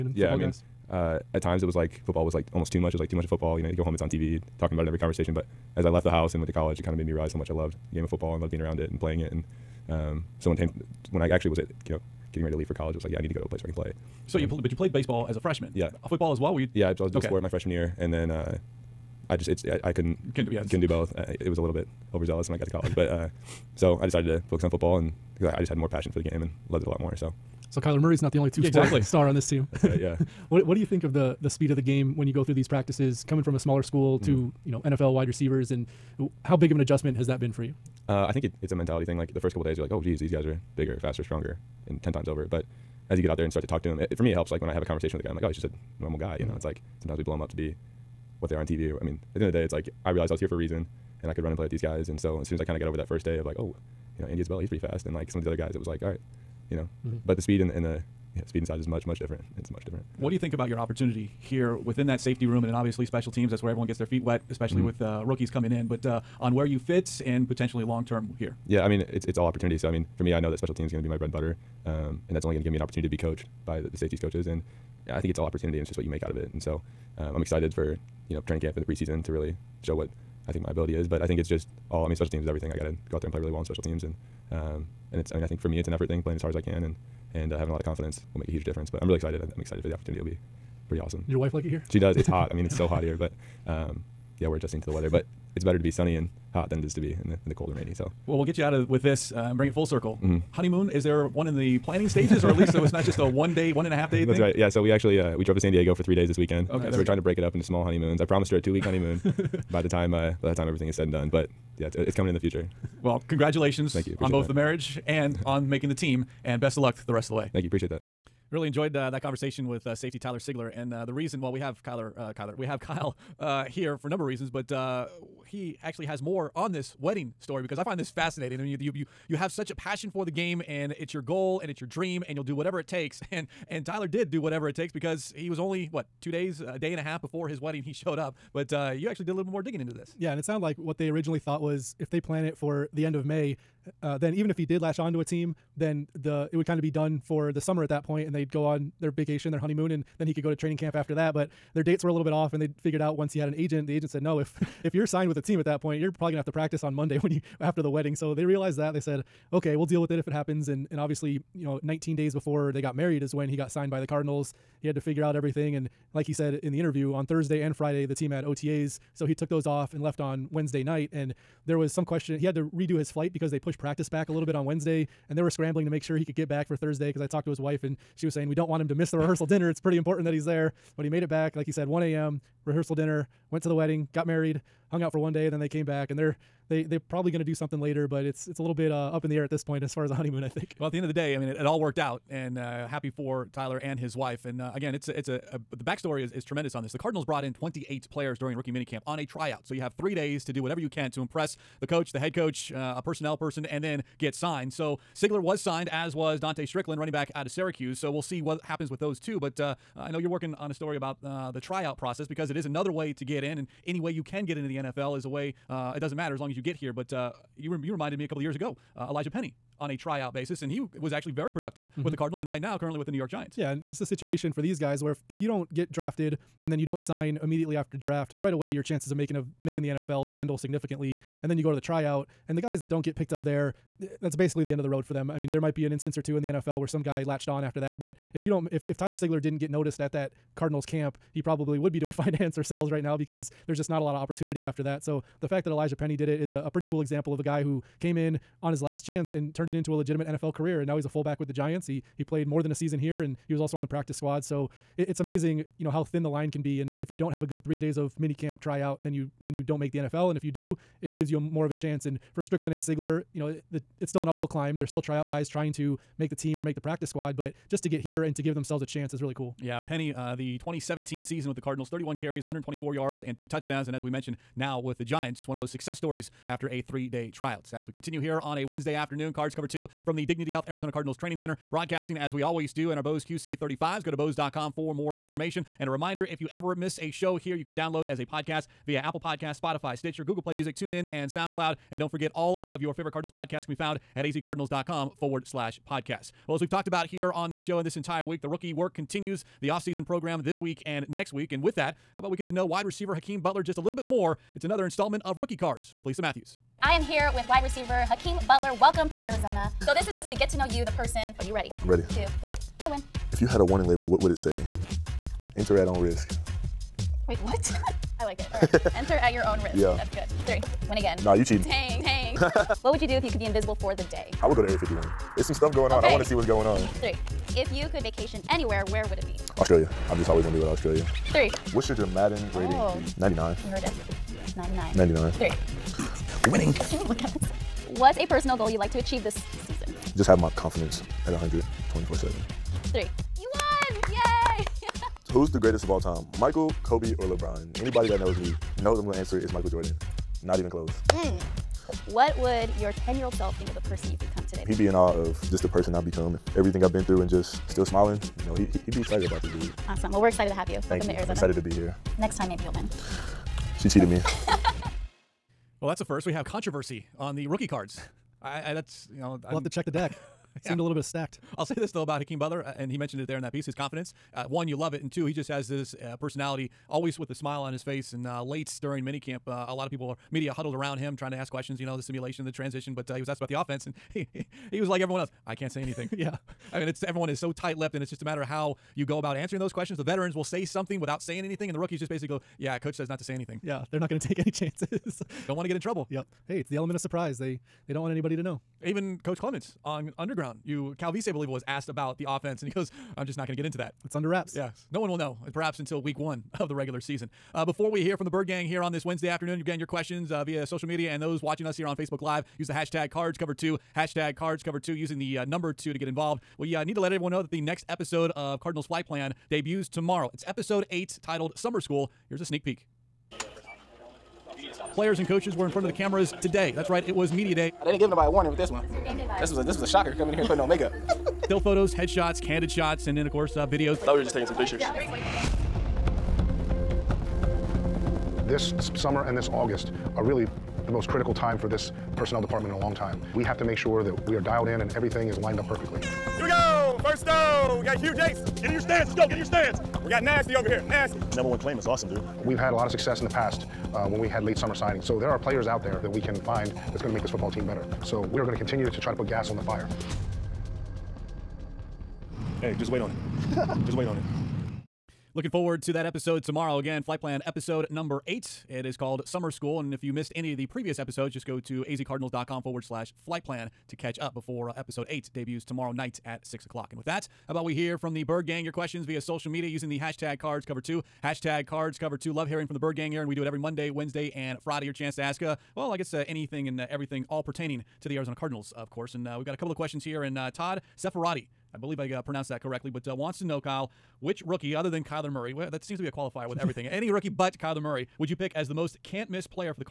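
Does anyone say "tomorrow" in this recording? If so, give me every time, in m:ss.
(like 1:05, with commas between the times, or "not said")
6:59, 7:46, 7:55.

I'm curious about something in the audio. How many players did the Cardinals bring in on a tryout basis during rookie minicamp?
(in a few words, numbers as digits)
28.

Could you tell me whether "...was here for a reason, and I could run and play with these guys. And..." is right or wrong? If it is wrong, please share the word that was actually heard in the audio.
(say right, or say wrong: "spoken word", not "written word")
right.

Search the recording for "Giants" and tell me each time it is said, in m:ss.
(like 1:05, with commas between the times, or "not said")
3:43, 4:11, 4:35.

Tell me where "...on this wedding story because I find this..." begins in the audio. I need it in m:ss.
2:06.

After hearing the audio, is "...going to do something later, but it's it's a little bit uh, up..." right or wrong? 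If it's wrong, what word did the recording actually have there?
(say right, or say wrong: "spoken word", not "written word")
right.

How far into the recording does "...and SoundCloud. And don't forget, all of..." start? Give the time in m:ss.
4:51.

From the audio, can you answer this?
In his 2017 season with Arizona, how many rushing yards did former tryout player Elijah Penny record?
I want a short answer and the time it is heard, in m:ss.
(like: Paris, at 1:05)
124, at 4:32.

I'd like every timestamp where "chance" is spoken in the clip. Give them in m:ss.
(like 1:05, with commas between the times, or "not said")
3:48, 4:09, 4:21, 4:28, 6:34, 8:04.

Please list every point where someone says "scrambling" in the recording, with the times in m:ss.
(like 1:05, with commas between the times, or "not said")
2:55.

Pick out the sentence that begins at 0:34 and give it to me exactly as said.
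to, you know, NFL wide receivers and how big of an adjustment has that been for you?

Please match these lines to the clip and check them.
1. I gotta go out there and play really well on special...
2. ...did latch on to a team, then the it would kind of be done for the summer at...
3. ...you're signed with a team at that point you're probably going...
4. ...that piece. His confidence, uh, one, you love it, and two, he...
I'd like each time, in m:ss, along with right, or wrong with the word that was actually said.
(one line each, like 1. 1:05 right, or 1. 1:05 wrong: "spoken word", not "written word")
1. 1:22 right
2. 2:24 right
3. 2:34 right
4. 6:13 right.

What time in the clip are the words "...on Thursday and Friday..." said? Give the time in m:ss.
2:47.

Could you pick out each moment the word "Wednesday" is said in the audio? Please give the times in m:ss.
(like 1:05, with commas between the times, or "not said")
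2:50, 2:54, 4:38, 6:49, 8:03.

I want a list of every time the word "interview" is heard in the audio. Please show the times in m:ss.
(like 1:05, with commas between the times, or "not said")
2:46.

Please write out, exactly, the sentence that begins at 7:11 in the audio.
Still photos, headshots, candid shots, and then of course uh, videos.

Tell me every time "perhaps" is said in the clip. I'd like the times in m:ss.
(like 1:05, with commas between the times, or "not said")
6:45.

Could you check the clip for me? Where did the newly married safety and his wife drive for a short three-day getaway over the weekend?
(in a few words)
San Diego.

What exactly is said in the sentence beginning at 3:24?
So Sigler was signed, as was Dontae Strickland, running back out of Syracuse.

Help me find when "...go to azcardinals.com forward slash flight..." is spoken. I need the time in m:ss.
7:51.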